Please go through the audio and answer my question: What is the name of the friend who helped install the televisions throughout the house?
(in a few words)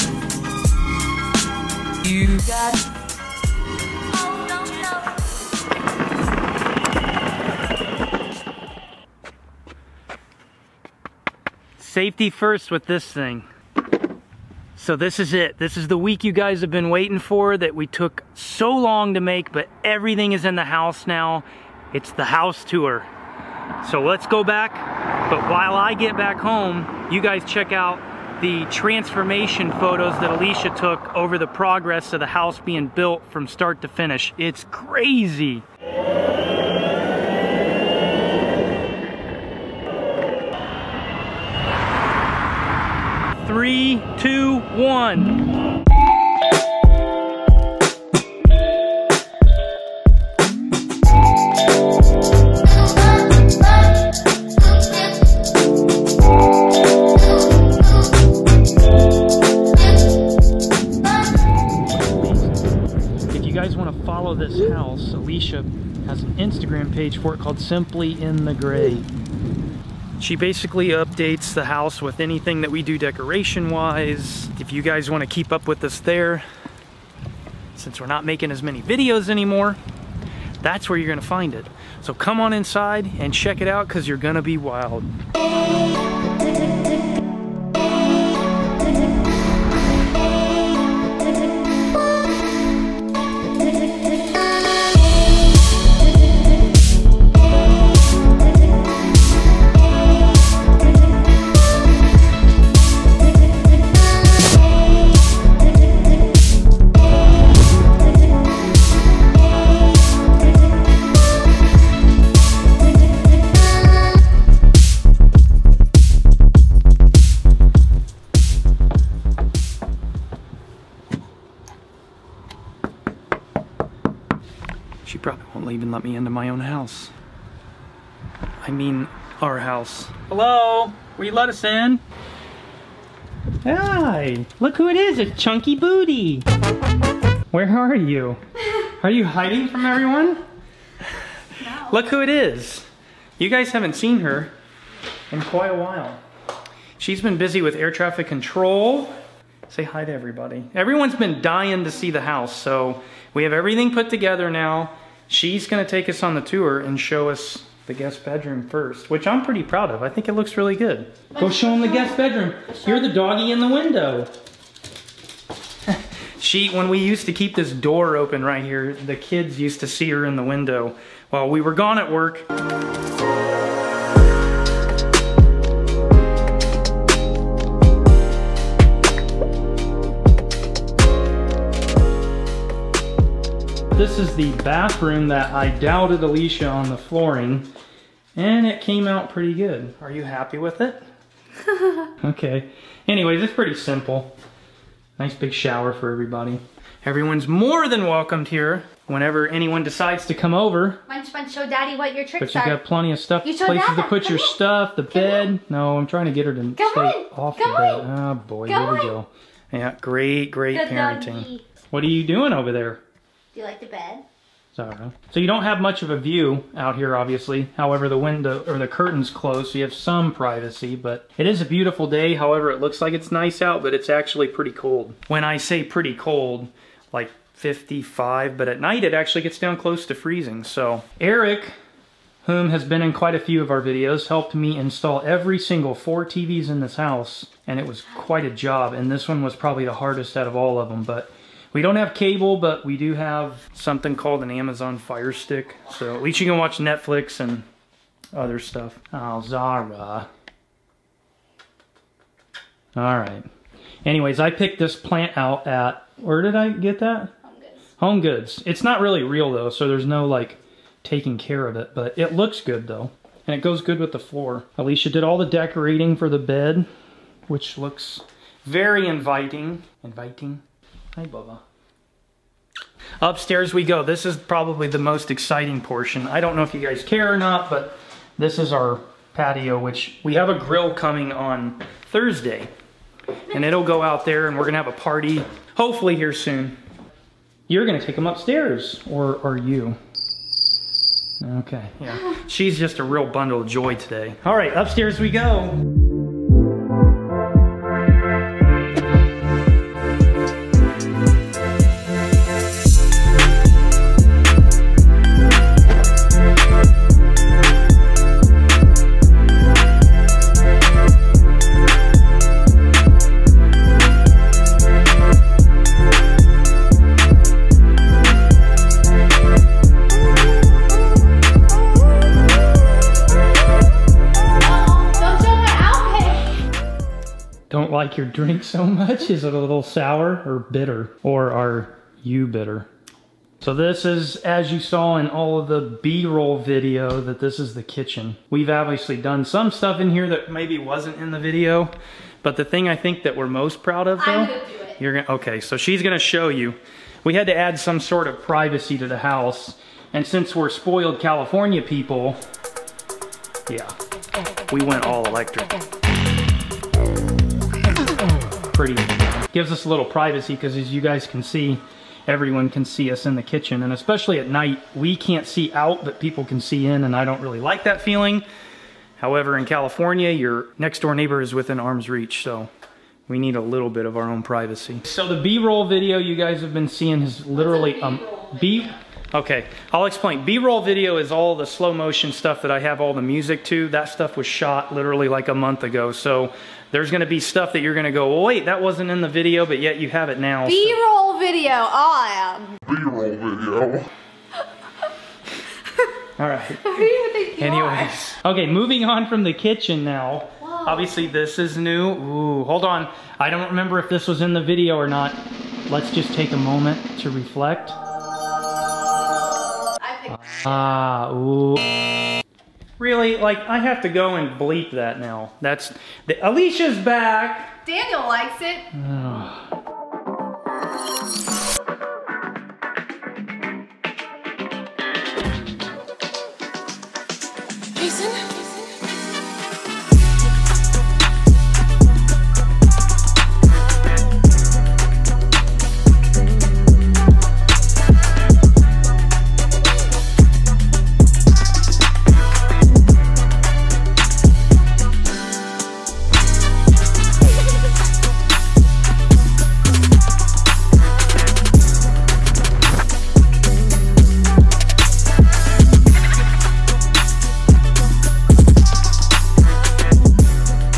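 Eric.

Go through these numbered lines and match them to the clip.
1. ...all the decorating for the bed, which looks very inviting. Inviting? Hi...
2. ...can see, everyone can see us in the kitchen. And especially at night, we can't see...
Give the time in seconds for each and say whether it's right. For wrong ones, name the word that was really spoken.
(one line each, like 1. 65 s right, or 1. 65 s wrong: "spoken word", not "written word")
1. 265 s right
2. 361 s right.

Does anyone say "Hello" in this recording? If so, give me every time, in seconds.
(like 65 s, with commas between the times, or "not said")
130 s.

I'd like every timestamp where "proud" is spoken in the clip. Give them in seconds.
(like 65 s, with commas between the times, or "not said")
159 s, 343 s.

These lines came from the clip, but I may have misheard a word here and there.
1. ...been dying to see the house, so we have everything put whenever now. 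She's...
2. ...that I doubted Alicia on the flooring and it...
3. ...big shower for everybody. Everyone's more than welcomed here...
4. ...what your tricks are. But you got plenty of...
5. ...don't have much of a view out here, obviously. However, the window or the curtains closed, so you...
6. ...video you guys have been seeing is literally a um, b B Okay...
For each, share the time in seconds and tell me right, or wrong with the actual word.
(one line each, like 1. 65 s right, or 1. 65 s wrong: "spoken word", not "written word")
1. 151 s wrong: "together", not "whenever"
2. 185 s right
3. 195 s right
4. 201 s right
5. 215 s right
6. 375 s right.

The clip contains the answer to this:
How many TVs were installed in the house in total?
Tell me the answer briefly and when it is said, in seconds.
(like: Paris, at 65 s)
4, at 235 s.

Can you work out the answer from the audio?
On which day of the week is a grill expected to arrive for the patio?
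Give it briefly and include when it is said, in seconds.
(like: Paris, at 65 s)
Thursday, at 282 s.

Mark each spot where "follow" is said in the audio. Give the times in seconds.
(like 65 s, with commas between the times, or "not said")
64 s.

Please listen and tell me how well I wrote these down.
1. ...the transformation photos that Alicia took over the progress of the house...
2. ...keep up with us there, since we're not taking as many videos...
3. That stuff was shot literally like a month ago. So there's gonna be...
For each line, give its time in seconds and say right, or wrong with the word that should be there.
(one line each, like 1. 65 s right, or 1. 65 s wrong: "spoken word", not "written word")
1. 28 s right
2. 75 s wrong: "making", not "taking"
3. 383 s right.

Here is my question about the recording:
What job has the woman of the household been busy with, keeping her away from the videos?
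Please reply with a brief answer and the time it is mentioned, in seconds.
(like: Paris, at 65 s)
Air traffic control, at 147 s.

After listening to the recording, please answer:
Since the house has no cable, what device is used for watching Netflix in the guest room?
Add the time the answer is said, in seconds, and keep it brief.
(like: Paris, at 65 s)
Amazon Fire Stick, at 244 s.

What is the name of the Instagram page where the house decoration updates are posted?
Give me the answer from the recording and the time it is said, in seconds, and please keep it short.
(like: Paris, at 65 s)
Simply in the Gray, at 67 s.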